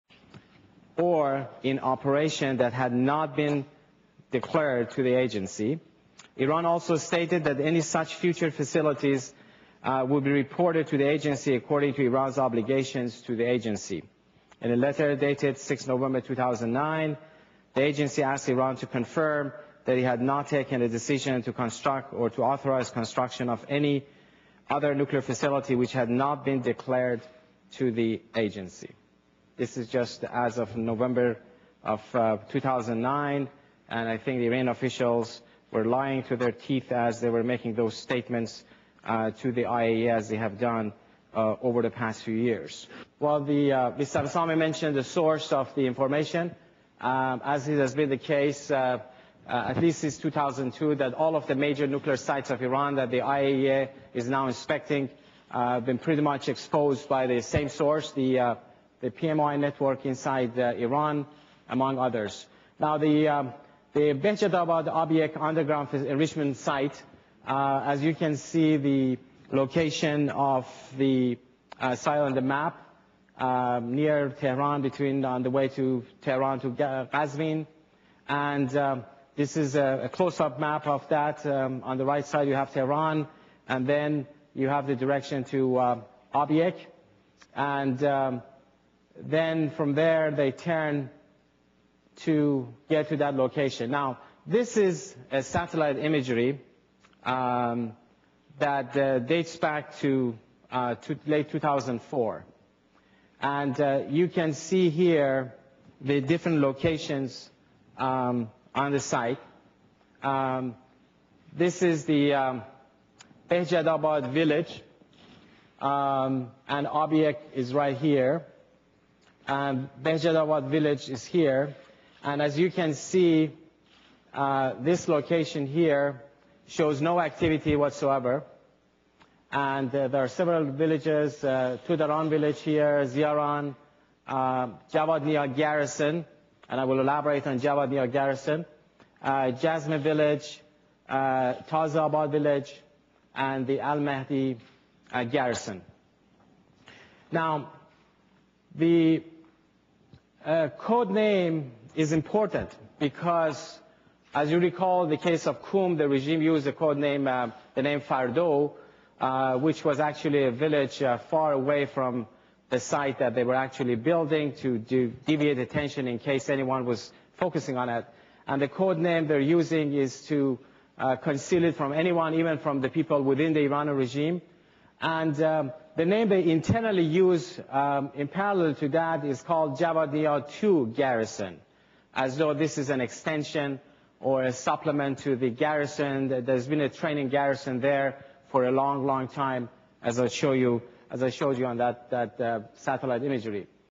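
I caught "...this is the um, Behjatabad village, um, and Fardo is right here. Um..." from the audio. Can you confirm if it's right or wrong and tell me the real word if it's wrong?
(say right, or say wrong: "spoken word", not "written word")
wrong: "Object", not "Fardo".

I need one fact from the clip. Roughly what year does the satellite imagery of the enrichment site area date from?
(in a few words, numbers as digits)
2004.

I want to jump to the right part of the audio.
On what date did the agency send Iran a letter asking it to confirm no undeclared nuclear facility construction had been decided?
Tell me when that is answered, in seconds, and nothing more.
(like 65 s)
15 s.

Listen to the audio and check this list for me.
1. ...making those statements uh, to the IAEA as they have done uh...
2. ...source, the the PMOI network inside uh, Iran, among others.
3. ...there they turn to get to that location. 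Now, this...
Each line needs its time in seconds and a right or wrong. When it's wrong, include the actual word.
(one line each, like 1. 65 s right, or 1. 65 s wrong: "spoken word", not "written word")
1. 37 s right
2. 57 s right
3. 89 s right.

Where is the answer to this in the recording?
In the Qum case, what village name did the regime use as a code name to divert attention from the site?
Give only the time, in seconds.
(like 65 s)
158 s.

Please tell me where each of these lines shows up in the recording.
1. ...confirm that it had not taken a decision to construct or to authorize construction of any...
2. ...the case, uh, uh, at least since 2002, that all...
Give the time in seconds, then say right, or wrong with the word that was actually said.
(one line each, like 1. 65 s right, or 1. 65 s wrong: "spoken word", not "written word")
1. 18 s right
2. 48 s right.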